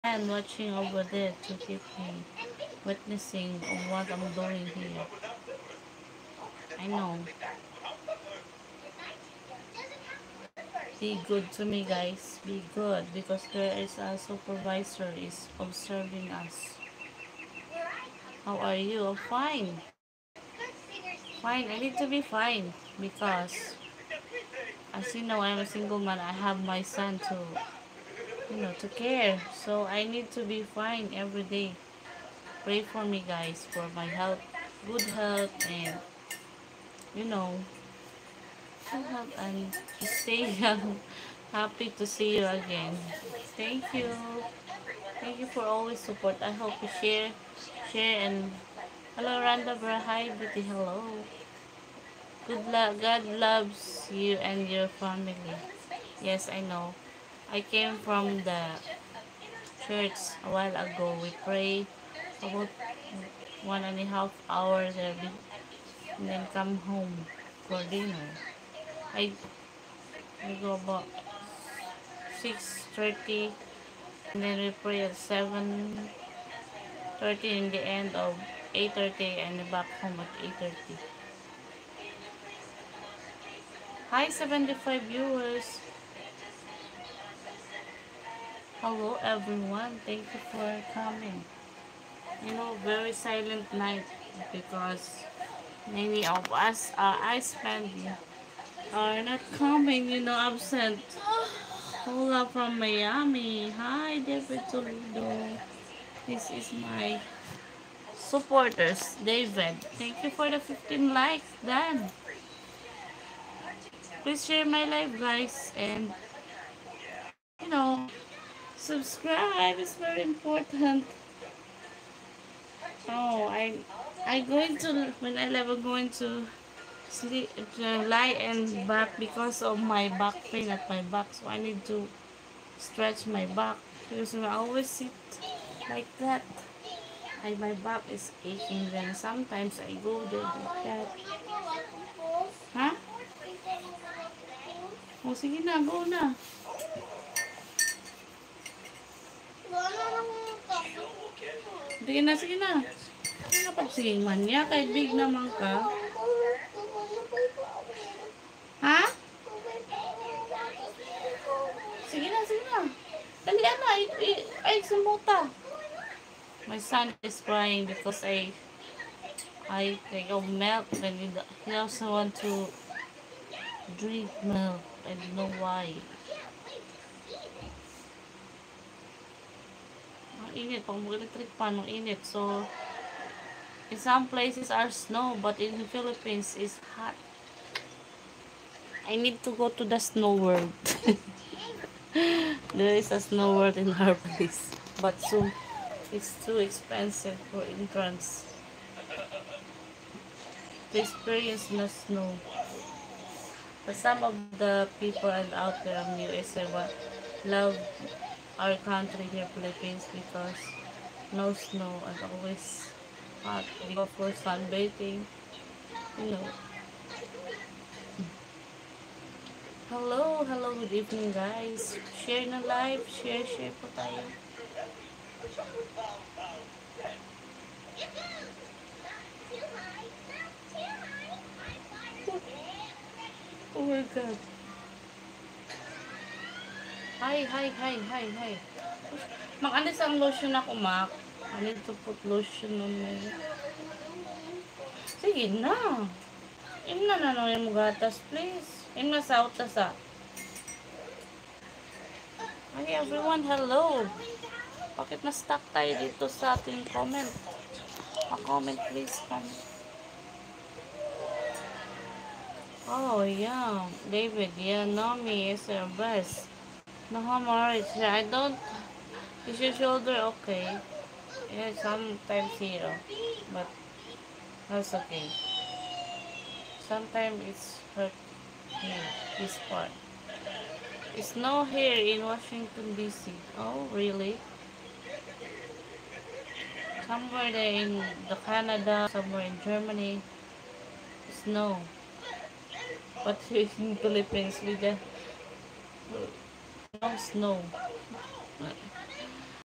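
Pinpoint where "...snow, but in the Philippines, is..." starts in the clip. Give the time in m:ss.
3:04.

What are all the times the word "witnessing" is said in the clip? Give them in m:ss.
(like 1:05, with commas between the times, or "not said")
0:02.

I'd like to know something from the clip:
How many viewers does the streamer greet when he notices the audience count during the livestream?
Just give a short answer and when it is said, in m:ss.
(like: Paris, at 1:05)
75, at 1:24.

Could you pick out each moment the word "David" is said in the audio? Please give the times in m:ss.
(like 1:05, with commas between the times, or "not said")
1:44, 1:49, 4:24.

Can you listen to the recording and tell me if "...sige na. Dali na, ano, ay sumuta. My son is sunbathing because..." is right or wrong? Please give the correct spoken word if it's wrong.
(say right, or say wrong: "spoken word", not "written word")
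wrong: "crying", not "sunbathing".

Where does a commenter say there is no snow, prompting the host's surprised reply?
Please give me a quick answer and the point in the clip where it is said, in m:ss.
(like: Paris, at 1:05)
Washington, D.C., at 4:42.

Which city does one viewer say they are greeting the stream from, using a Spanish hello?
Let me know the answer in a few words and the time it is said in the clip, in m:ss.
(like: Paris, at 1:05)
Miami, at 1:42.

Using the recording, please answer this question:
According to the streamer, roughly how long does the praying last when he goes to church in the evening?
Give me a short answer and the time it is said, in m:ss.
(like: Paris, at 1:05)
1.5 hours, at 1:03.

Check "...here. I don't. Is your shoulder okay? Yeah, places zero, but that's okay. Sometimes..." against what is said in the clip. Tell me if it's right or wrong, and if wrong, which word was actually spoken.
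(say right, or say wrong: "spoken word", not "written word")
wrong: "sometimes", not "places".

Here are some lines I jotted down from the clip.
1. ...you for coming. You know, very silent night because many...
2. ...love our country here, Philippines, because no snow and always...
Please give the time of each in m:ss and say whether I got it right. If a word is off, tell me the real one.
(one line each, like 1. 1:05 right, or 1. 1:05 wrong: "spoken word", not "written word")
1. 1:30 right
2. 3:27 right.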